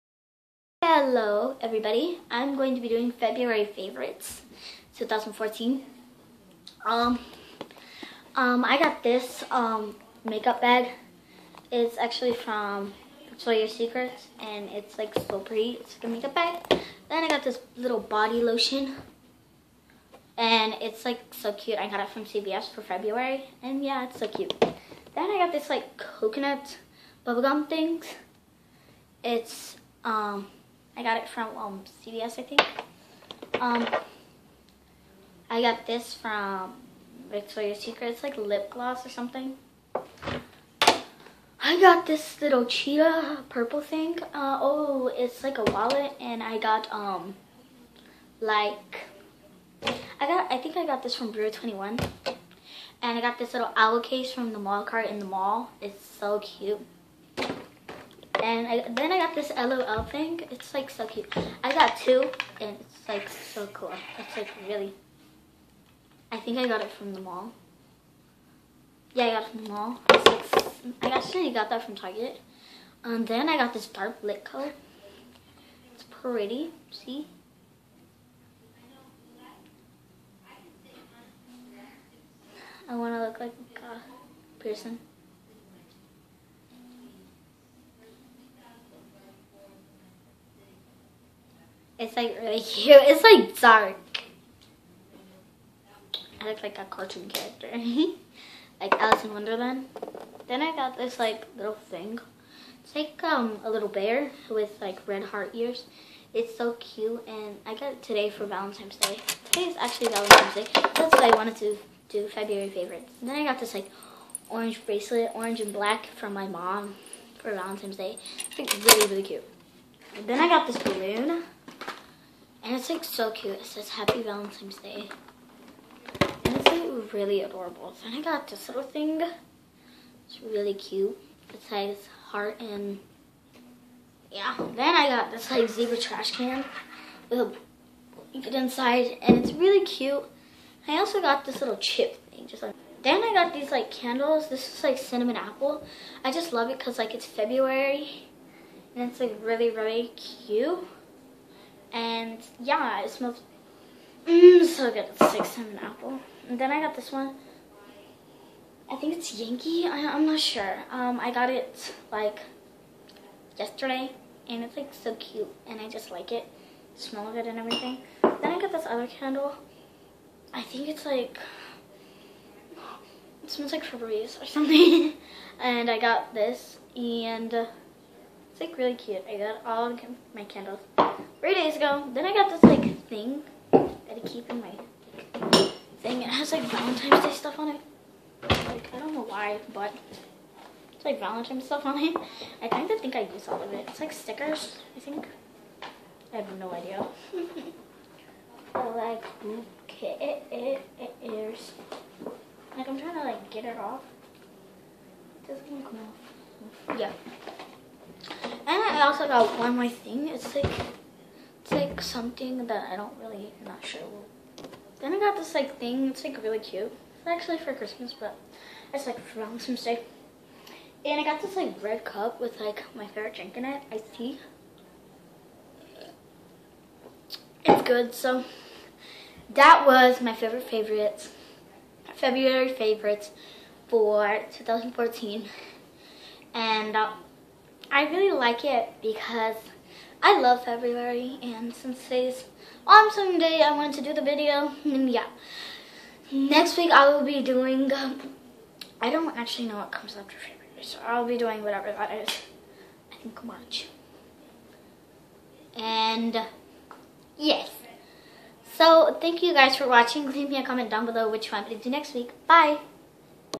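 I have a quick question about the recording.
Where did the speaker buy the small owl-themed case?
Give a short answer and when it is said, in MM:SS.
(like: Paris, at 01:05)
the mall cart, at 00:54.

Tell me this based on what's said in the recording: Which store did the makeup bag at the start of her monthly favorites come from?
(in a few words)
Victoria's Secret.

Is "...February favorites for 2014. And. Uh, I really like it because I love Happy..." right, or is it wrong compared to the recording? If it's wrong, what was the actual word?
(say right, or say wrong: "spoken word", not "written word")
wrong: "February", not "Happy".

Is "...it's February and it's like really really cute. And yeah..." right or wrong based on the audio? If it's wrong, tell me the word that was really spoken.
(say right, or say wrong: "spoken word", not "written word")
right.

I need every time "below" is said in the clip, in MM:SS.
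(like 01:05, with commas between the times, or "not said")
04:21.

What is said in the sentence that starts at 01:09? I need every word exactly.
Yeah, I got it from the mall.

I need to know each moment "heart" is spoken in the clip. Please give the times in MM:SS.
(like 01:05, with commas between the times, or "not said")
01:45, 02:12.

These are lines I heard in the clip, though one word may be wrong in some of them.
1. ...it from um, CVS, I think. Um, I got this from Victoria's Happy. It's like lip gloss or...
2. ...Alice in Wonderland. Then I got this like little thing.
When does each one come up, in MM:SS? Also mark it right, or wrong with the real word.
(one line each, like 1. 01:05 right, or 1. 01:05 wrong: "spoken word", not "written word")
1. 00:31 wrong: "Secret", not "Happy"
2. 01:38 right.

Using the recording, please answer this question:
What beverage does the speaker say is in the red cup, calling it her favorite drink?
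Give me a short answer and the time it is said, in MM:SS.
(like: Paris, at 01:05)
iced tea, at 03:43.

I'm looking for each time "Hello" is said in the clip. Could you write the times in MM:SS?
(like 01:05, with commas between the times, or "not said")
00:01.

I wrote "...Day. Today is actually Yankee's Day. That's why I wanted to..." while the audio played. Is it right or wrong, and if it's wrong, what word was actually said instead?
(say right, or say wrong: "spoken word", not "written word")
wrong: "Valentine", not "Yankee".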